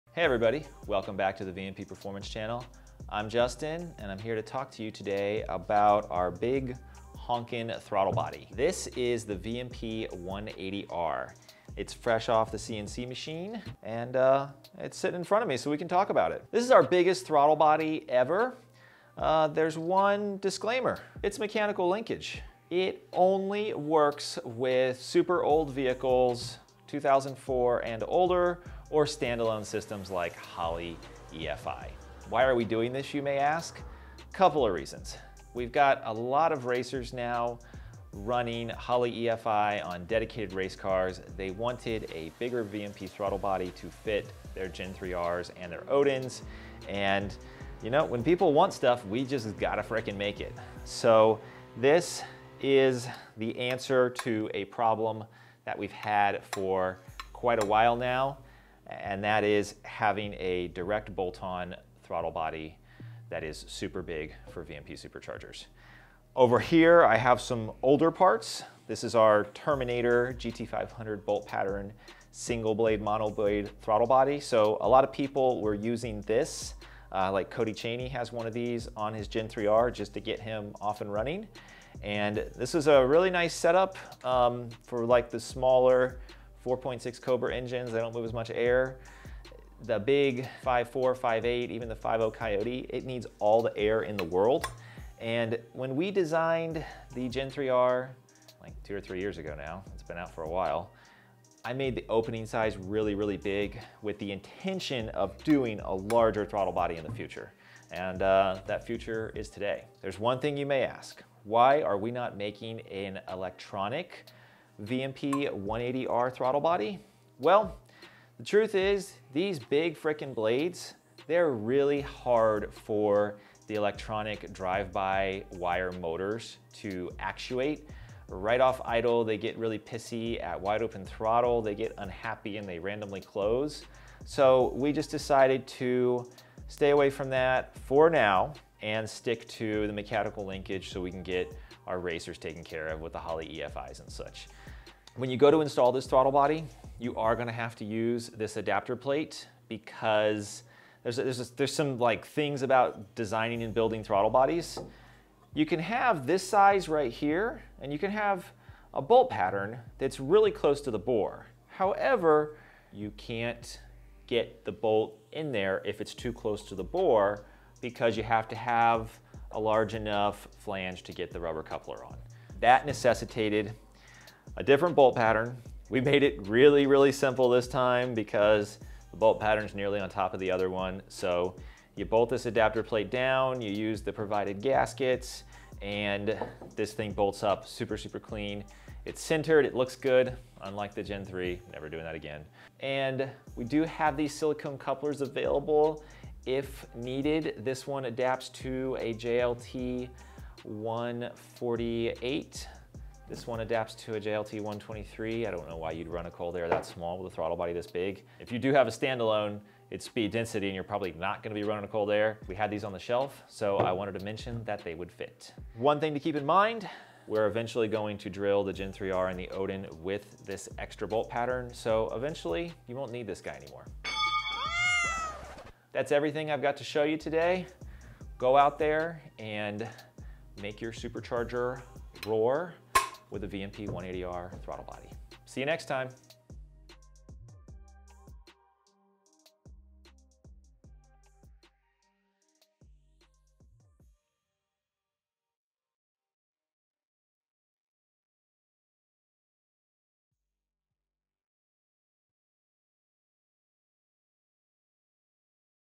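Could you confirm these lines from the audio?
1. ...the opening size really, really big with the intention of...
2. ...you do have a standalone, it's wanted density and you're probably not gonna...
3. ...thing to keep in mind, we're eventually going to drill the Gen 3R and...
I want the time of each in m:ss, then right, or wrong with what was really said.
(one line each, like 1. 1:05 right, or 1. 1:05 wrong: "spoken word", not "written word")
1. 1:41 right
2. 3:28 wrong: "speed", not "wanted"
3. 3:36 right.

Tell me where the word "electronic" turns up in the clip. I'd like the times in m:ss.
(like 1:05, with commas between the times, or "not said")
1:53, 2:03.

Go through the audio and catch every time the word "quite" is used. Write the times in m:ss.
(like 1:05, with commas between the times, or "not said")
0:57.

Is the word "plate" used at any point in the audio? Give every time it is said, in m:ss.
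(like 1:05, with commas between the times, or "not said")
2:28, 3:02.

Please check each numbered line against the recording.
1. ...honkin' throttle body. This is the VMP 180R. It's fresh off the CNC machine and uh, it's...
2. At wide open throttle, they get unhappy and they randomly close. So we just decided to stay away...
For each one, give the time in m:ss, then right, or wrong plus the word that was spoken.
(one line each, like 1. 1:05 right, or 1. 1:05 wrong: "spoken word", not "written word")
1. 0:07 right
2. 2:10 right.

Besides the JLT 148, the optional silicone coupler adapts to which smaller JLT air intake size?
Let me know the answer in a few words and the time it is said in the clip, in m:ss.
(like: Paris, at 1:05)
JLT 123, at 3:24.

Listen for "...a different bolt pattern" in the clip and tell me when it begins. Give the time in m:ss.
2:54.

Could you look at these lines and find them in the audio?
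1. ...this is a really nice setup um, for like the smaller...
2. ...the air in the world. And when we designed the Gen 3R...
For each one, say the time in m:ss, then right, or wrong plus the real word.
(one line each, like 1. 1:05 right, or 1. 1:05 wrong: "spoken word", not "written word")
1. 1:22 right
2. 1:33 right.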